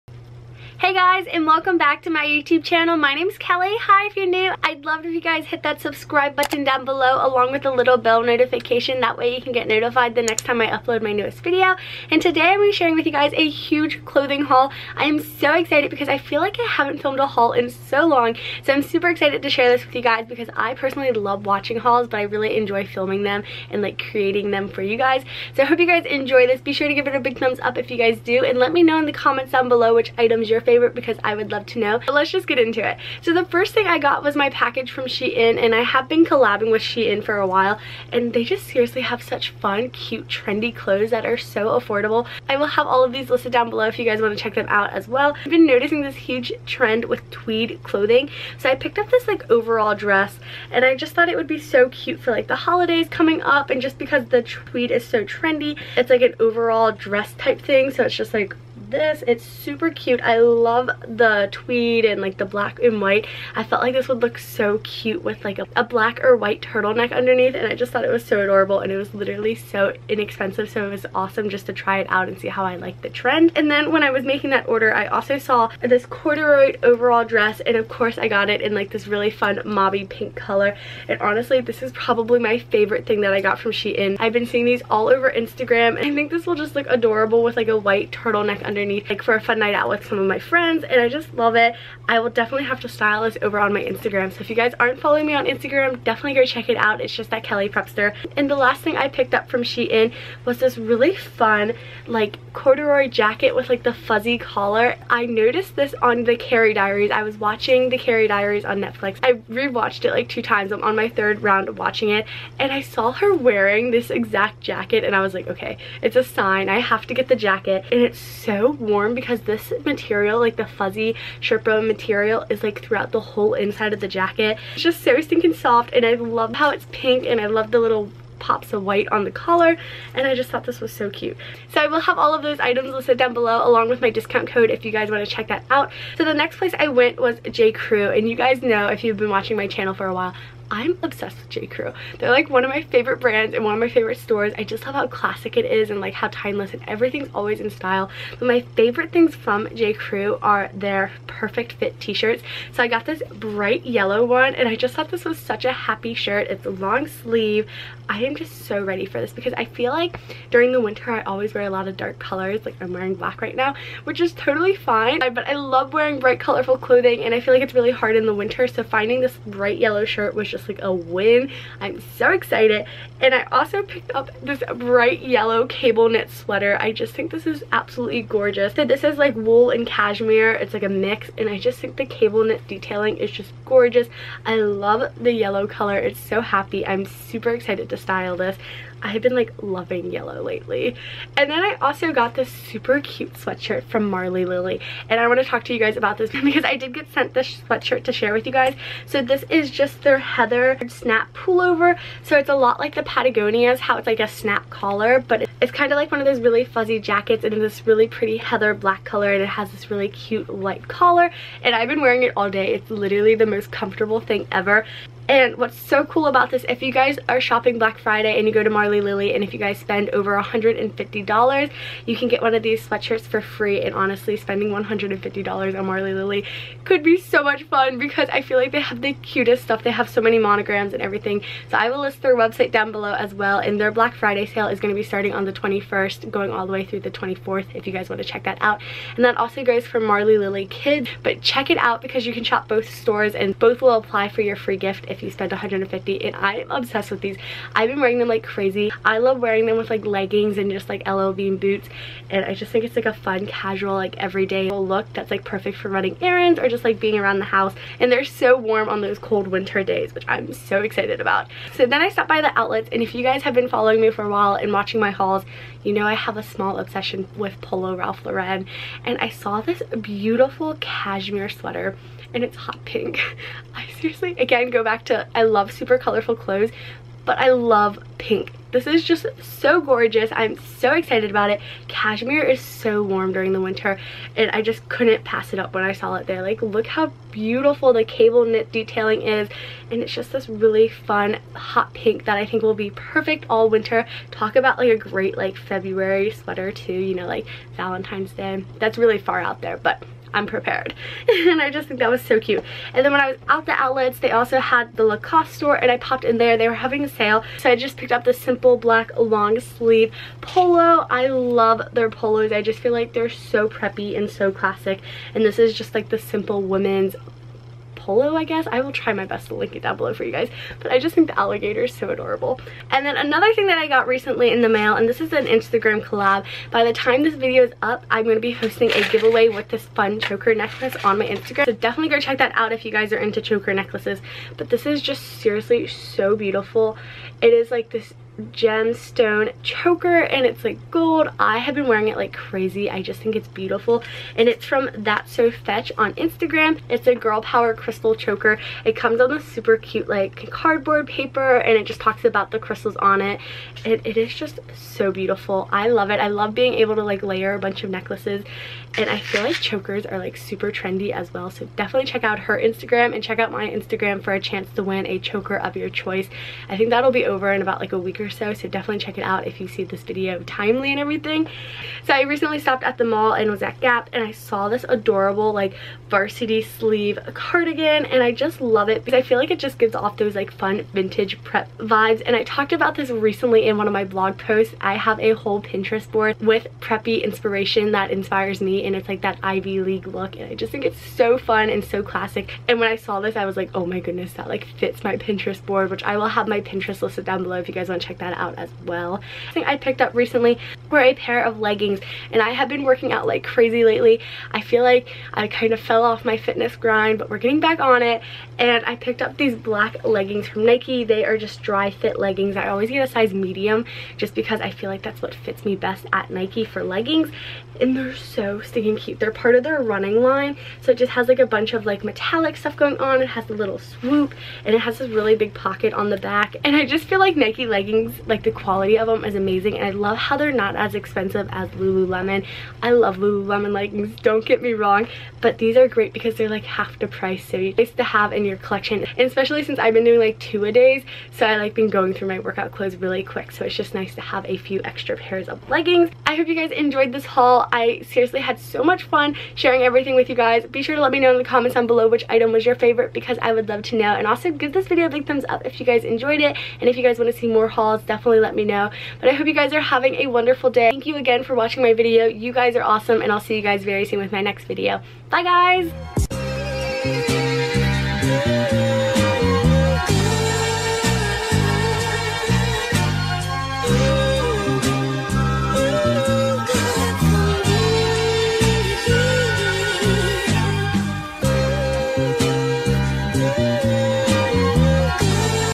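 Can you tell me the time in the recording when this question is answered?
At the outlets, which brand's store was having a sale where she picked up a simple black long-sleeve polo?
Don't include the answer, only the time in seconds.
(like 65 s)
305 s.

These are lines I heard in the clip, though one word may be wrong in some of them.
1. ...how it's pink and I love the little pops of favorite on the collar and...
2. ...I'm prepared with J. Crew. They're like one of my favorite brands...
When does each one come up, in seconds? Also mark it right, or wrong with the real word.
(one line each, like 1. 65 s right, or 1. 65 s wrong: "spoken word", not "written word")
1. 126 s wrong: "white", not "favorite"
2. 140 s wrong: "obsessed", not "prepared".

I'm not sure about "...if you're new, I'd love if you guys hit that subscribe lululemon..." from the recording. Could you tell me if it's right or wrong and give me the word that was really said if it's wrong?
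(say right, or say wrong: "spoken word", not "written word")
wrong: "button", not "lululemon".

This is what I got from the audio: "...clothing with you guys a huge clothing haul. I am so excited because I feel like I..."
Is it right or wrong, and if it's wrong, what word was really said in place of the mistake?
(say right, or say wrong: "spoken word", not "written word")
wrong: "sharing", not "clothing".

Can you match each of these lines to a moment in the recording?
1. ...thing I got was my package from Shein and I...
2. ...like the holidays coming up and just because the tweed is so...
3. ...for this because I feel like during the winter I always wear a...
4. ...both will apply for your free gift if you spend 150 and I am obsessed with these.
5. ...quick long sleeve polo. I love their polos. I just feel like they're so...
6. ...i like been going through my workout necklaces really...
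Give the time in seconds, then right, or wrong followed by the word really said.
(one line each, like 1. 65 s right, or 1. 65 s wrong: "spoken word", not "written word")
1. 33 s right
2. 52 s right
3. 159 s right
4. 243 s right
5. 308 s wrong: "black", not "quick"
6. 441 s wrong: "clothes", not "necklaces".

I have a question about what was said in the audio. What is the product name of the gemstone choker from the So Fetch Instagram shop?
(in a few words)
girl power crystal choker.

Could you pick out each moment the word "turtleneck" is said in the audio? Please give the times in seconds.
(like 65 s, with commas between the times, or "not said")
66 s, 88 s.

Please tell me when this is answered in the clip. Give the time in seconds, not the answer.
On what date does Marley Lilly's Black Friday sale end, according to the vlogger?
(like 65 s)
236 s.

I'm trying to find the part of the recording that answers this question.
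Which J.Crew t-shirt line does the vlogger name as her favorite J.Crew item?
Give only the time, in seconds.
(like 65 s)
151 s.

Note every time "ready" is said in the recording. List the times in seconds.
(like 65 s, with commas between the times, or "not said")
158 s.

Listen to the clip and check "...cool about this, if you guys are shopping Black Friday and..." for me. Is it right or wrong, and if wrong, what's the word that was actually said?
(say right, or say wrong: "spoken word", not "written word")
right.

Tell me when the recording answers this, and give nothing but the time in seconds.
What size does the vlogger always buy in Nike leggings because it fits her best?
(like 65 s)
413 s.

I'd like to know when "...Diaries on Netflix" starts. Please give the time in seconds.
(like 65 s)
108 s.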